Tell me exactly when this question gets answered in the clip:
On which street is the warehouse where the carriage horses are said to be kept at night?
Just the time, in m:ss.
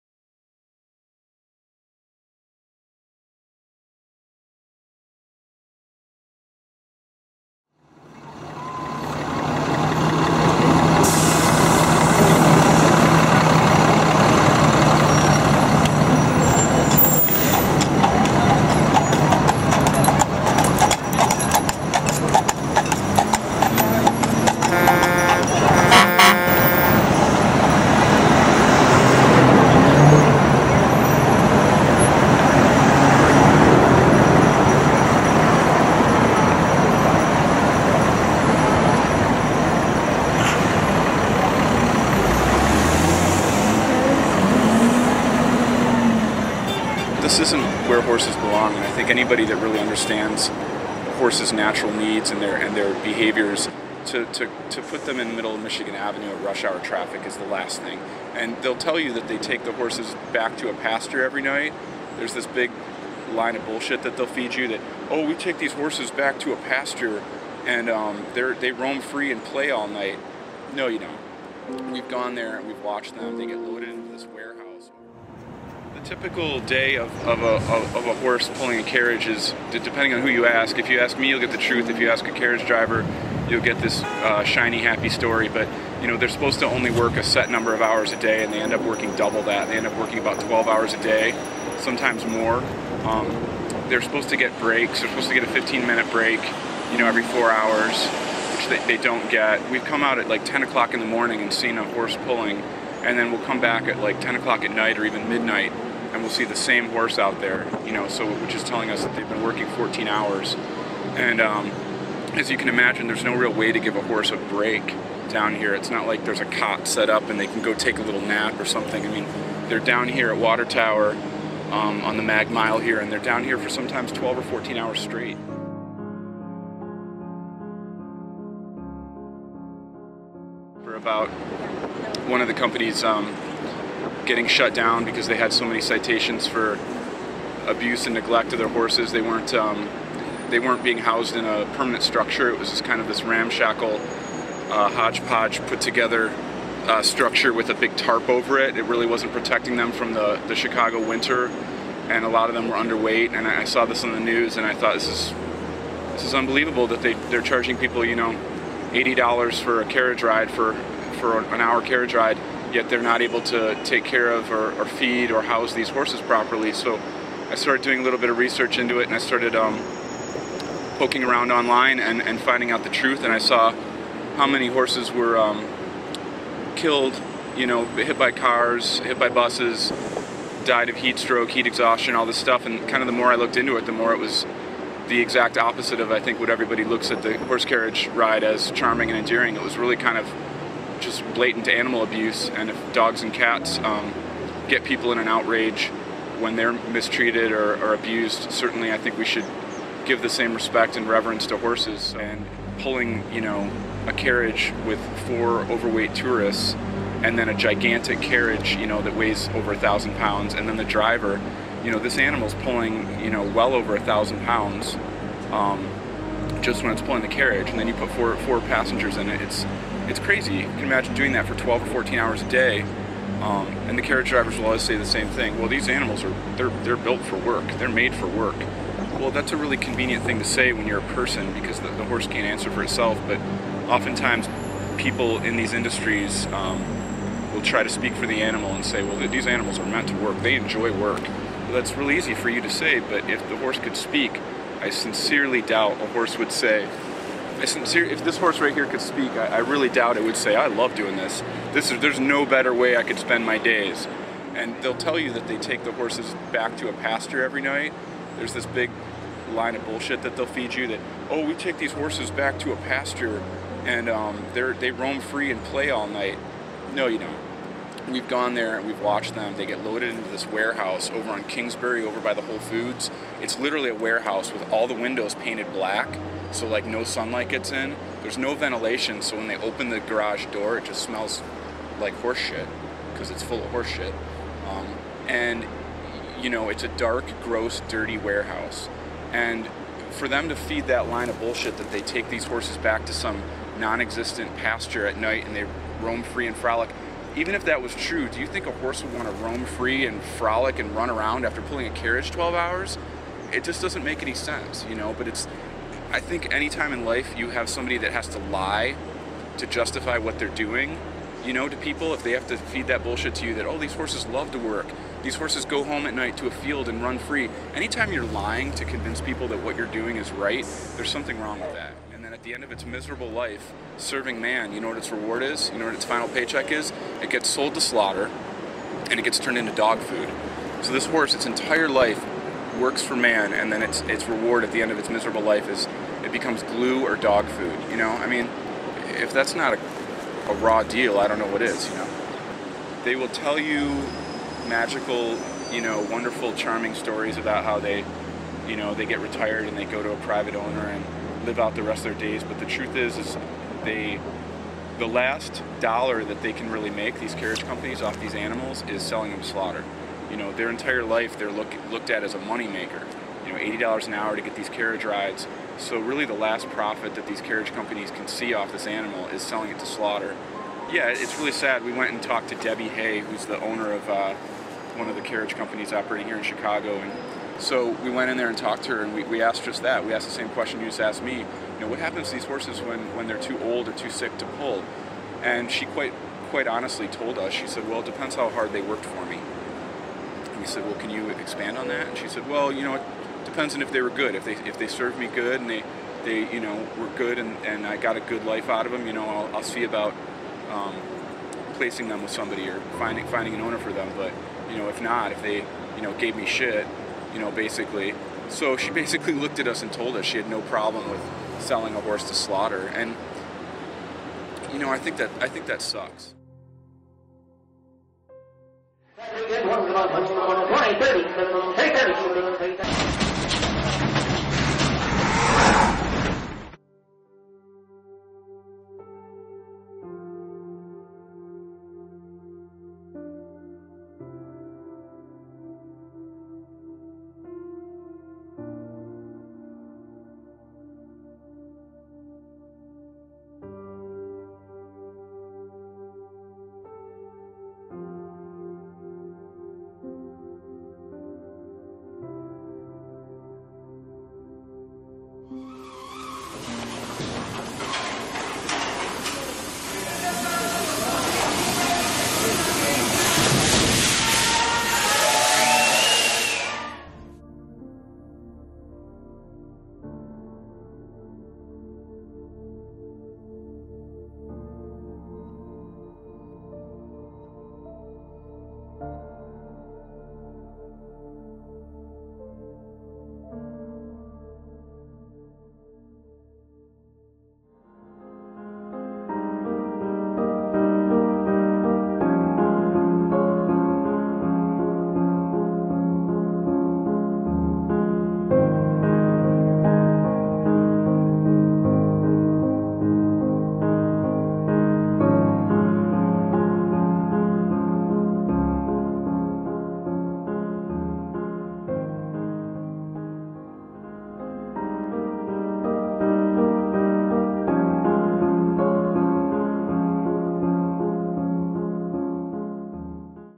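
4:31.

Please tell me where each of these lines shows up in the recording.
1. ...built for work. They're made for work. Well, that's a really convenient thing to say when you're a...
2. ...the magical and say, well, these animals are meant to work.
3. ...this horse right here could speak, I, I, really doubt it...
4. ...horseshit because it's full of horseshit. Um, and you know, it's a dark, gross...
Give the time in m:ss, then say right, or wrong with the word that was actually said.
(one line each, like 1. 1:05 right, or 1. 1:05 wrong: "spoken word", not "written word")
1. 3:46 right
2. 3:58 wrong: "animal", not "magical"
3. 4:08 right
4. 4:42 right.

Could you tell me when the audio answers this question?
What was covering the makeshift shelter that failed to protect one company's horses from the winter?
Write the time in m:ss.
2:27.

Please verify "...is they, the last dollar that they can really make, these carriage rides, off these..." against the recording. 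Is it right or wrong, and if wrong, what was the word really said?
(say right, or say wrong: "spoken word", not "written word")
wrong: "companies", not "rides".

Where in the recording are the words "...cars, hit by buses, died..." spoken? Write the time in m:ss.
2:58.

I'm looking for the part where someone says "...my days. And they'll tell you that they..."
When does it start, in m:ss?
4:13.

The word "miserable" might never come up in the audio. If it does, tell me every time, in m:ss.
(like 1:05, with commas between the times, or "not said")
5:22, 5:35.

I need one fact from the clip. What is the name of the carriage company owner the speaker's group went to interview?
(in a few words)
Debbie Hay.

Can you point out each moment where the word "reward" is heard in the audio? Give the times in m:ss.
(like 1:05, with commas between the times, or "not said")
5:25, 5:34.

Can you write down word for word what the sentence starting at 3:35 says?
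Um, just when it's pulling the carriage, and then you put four four passengers in it.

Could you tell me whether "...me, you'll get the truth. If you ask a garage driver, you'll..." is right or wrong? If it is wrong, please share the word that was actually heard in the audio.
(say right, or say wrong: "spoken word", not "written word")
wrong: "carriage", not "garage".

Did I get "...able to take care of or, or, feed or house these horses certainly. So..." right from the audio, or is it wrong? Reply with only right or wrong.
wrong.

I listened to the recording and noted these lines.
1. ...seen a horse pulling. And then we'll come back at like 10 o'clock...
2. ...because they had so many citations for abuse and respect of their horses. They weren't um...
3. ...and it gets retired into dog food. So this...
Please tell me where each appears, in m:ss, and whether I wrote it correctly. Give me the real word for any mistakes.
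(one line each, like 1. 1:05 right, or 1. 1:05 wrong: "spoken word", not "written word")
1. 1:41 right
2. 2:15 wrong: "neglect", not "respect"
3. 5:29 wrong: "turned", not "retired".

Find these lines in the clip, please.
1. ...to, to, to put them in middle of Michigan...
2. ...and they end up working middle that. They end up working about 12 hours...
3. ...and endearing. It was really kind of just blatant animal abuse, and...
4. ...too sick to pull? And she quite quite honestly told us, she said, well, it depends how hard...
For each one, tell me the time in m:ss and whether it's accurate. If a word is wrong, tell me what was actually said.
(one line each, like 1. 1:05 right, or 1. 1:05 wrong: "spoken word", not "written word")
1. 0:54 right
2. 1:28 wrong: "double", not "middle"
3. 3:09 right
4. 6:23 right.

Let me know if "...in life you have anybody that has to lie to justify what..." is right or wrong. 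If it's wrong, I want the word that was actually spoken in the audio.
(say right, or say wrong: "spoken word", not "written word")
wrong: "somebody", not "anybody".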